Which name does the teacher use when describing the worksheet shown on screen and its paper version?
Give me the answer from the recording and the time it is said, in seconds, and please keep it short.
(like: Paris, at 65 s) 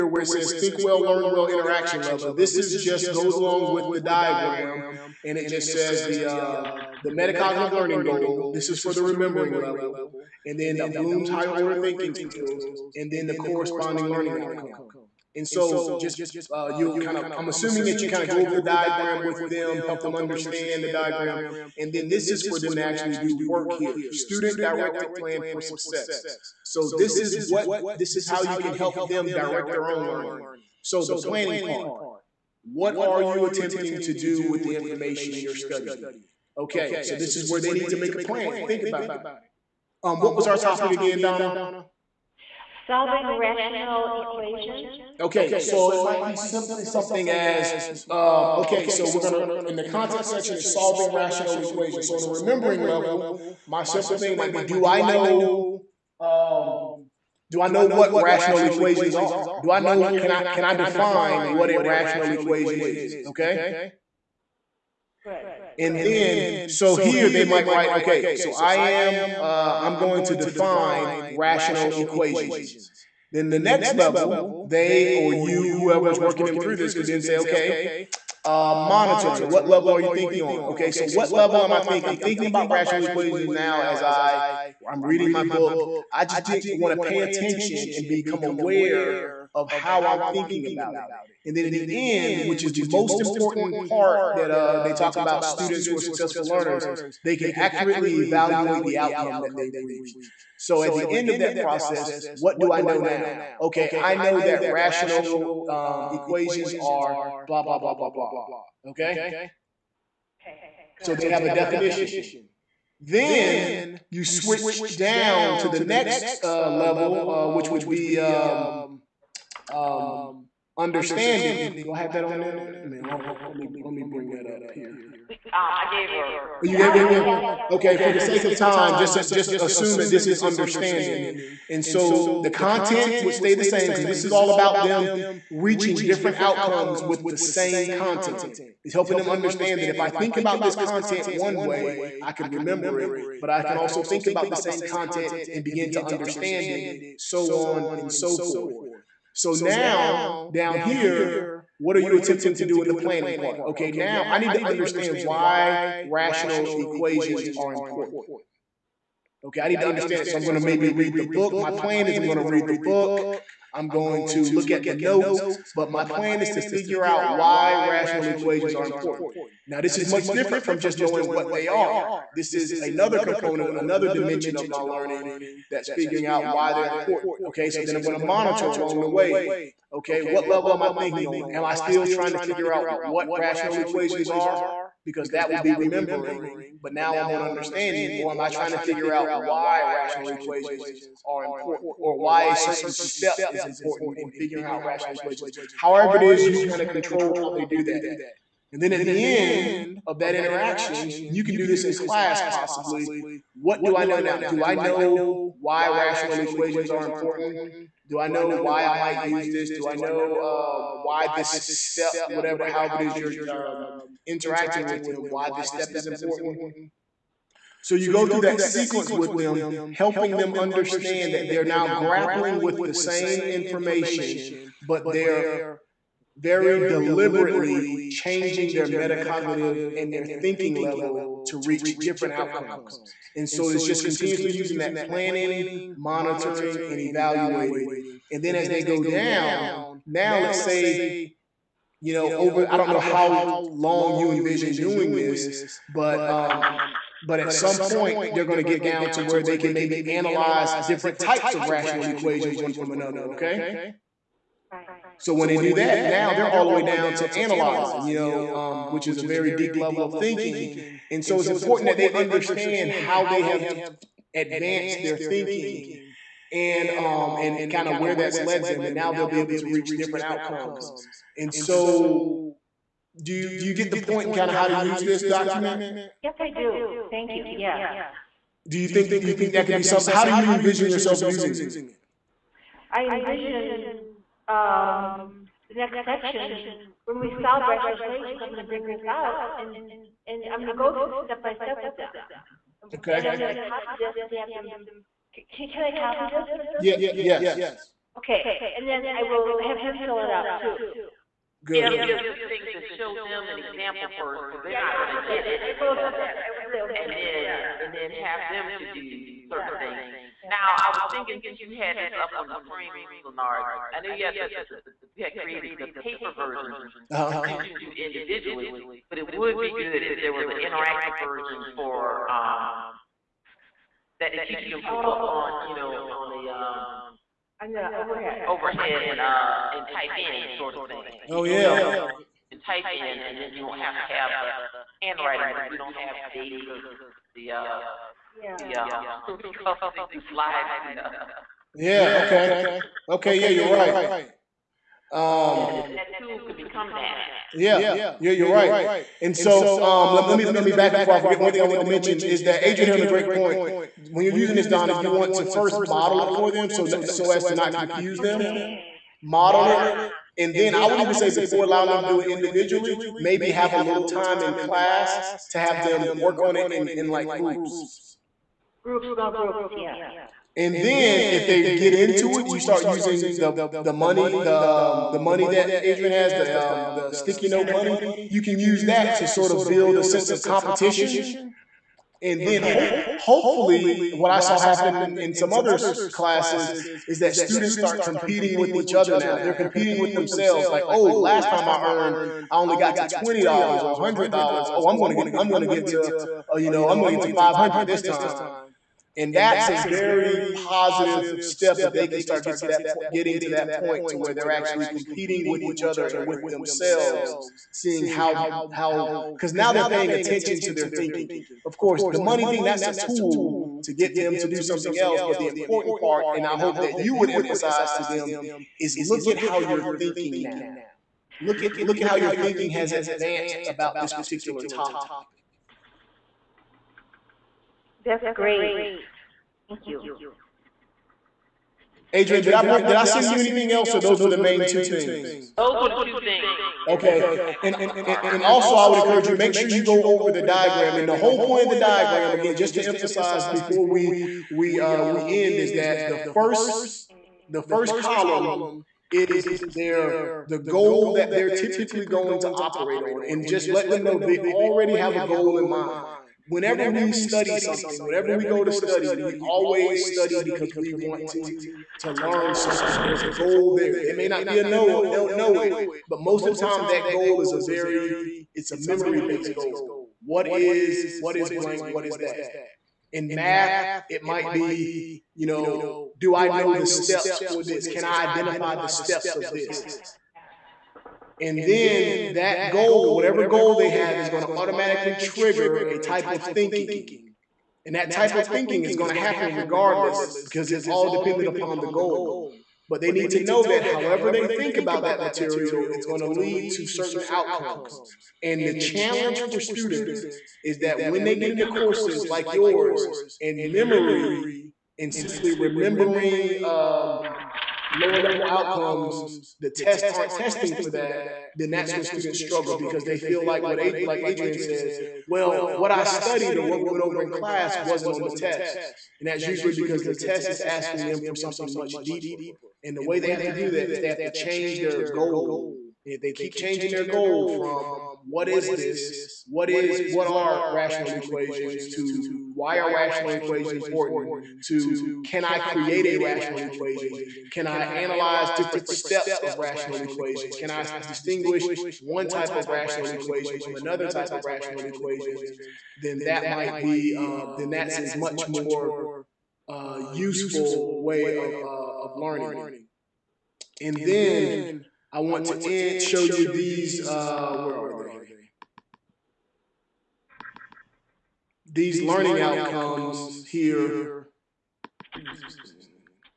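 Leonard, at 313 s.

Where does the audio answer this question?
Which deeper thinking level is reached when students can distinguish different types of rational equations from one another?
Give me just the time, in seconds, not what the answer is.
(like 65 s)
257 s.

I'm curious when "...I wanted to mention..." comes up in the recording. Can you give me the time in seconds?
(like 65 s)
351 s.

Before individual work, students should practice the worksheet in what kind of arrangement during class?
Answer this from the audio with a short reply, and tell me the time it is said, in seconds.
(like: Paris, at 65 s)
Small groups, at 369 s.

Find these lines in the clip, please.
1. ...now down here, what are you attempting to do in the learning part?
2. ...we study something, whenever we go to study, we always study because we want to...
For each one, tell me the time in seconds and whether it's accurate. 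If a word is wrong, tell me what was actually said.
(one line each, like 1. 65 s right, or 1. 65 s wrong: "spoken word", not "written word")
1. 149 s wrong: "planning", not "learning"
2. 456 s right.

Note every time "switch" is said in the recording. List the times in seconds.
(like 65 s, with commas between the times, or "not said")
114 s.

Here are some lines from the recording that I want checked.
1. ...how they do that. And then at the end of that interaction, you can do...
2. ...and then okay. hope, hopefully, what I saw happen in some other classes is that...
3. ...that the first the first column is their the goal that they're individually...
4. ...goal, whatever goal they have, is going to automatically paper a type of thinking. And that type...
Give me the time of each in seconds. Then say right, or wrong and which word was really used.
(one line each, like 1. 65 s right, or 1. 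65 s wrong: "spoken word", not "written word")
1. 197 s right
2. 382 s right
3. 445 s wrong: "typically", not "individually"
4. 482 s wrong: "trigger", not "paper".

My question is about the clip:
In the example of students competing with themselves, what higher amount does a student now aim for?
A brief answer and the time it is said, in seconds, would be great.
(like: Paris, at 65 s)
500, at 397 s.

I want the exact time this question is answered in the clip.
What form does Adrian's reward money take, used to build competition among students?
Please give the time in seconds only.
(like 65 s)
377 s.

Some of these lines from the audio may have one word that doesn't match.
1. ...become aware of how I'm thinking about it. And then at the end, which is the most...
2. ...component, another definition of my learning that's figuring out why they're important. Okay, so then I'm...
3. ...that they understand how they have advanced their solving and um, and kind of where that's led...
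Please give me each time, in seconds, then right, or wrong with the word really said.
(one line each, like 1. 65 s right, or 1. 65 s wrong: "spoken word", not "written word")
1. 88 s right
2. 173 s wrong: "dimension", not "definition"
3. 261 s wrong: "thinking", not "solving".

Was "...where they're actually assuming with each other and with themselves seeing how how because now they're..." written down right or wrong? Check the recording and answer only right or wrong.
wrong.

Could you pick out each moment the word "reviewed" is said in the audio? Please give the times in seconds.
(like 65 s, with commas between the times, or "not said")
not said.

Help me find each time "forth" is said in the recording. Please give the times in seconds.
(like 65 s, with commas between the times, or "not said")
148 s.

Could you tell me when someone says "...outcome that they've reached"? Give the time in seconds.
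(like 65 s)
98 s.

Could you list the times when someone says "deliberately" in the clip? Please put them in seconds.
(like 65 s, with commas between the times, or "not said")
226 s.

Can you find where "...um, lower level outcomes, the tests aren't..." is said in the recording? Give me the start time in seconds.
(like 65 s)
506 s.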